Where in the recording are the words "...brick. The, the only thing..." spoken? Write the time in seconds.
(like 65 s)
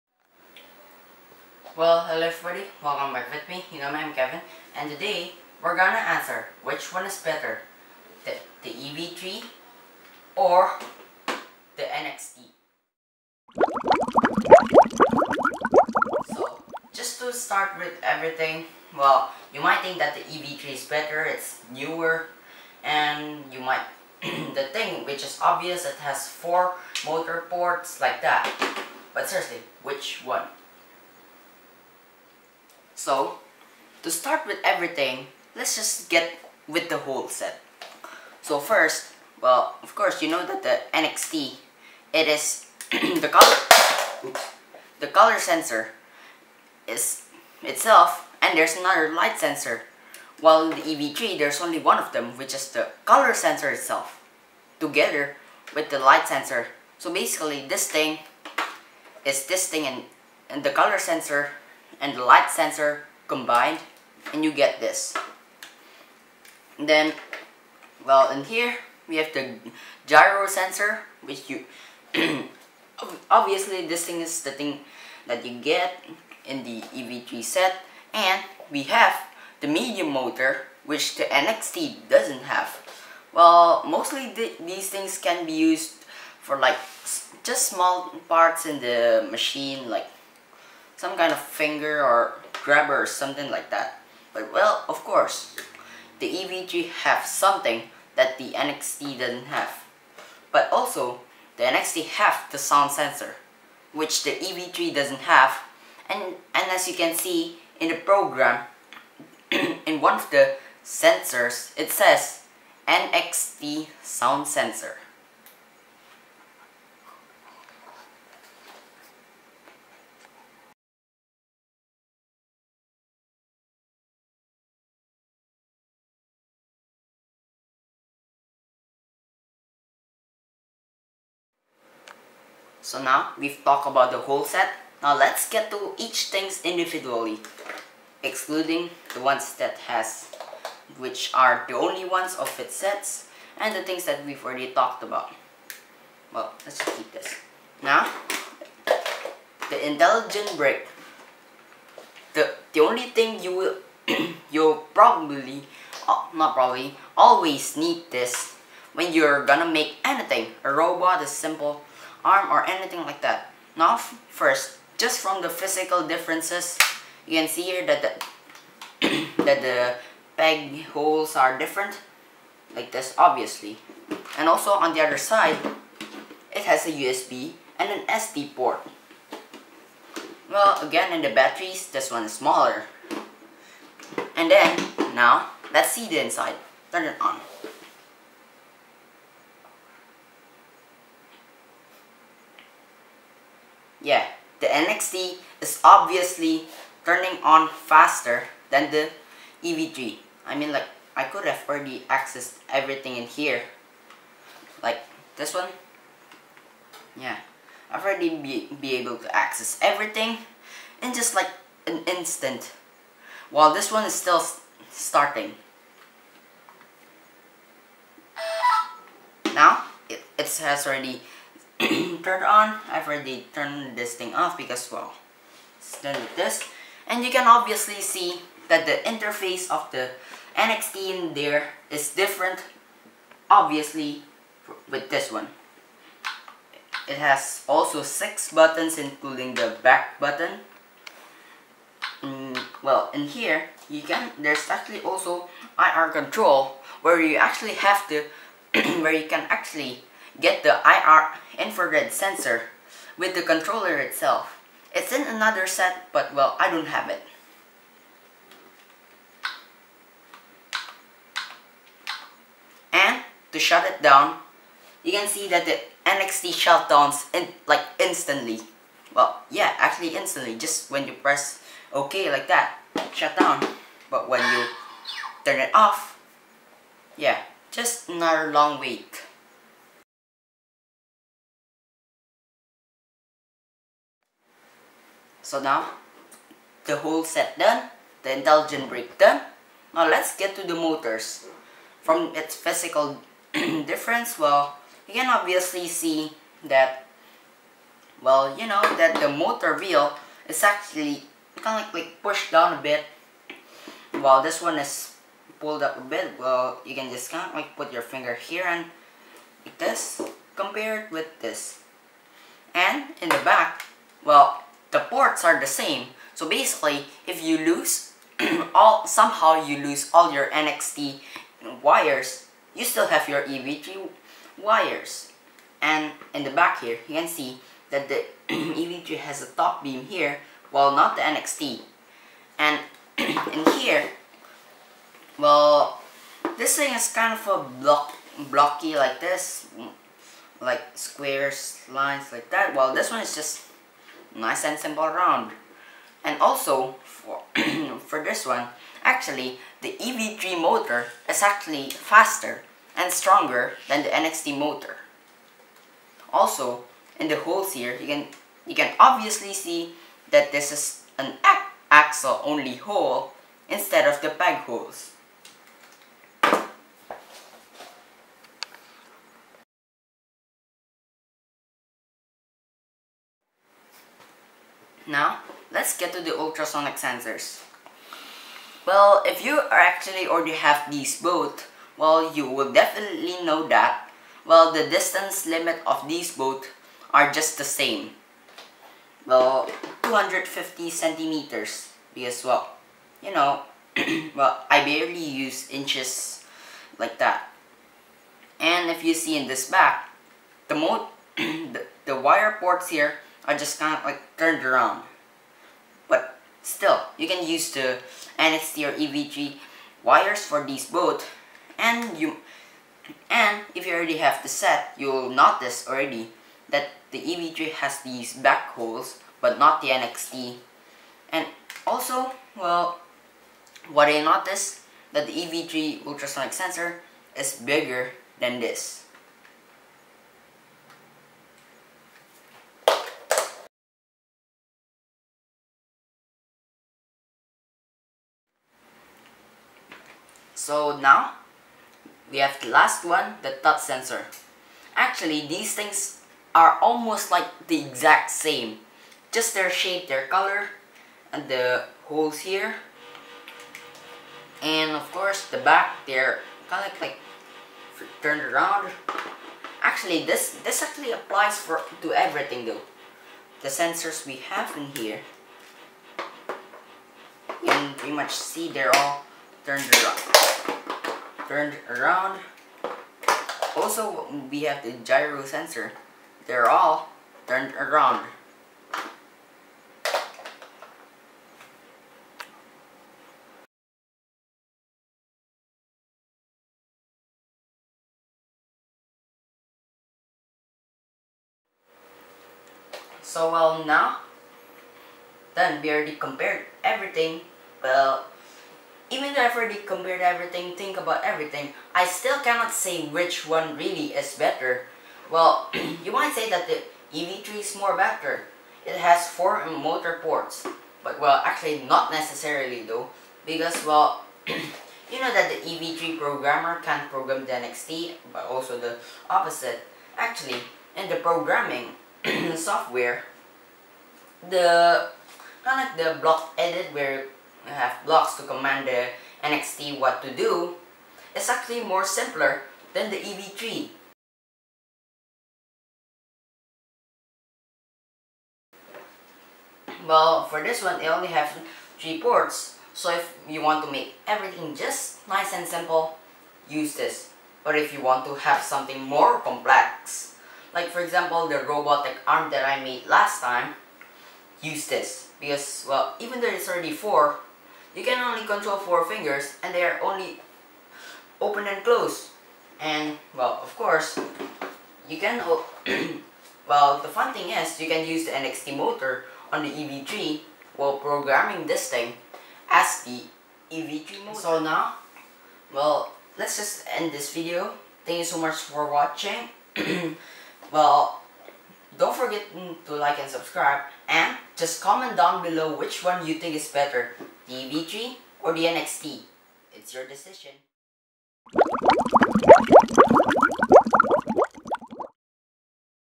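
150 s.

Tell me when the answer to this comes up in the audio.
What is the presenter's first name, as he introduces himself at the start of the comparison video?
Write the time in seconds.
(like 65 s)
4 s.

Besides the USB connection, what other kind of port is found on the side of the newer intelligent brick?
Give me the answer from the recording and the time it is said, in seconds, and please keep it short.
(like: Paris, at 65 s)
SD port, at 178 s.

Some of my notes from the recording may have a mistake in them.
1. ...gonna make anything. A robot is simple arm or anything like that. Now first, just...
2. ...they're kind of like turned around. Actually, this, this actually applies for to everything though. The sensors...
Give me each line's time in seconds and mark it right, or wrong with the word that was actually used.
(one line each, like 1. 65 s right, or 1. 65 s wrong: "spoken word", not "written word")
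1. 159 s right
2. 456 s right.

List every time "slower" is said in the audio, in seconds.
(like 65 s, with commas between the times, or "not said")
not said.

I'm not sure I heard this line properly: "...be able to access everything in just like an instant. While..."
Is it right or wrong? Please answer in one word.
right.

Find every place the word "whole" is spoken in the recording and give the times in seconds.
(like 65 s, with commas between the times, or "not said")
37 s, 134 s, 286 s.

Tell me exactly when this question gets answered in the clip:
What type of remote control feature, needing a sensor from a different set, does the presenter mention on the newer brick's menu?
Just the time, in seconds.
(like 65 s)
245 s.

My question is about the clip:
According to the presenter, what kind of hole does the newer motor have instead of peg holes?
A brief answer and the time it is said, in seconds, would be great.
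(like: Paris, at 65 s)
axle-only hole, at 361 s.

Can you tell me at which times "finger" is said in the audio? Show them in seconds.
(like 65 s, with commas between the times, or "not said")
91 s, 308 s, 559 s.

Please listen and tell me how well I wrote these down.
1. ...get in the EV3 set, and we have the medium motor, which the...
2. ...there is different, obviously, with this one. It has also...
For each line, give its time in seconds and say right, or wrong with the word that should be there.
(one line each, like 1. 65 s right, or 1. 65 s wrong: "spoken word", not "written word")
1. 75 s right
2. 231 s right.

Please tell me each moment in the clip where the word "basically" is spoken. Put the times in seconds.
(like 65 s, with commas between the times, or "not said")
57 s, 316 s.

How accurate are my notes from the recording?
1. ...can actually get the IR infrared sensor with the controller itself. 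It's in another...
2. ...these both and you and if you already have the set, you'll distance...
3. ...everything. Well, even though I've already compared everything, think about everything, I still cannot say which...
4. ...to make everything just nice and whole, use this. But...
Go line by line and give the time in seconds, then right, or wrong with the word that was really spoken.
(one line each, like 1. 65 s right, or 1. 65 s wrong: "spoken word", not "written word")
1. 249 s right
2. 410 s wrong: "notice", not "distance"
3. 496 s right
4. 543 s wrong: "simple", not "whole".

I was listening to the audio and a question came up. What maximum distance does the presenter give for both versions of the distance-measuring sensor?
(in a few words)
250 centimeters.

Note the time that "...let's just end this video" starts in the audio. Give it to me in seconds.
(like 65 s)
576 s.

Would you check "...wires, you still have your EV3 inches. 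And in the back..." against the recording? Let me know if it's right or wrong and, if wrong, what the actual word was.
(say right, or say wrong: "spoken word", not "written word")
wrong: "wires", not "inches".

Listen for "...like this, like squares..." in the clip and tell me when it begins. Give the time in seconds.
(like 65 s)
338 s.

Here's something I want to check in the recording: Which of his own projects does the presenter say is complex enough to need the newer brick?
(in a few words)
robotic arm.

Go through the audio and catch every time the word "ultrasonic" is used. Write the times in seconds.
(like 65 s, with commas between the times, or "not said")
376 s, 426 s.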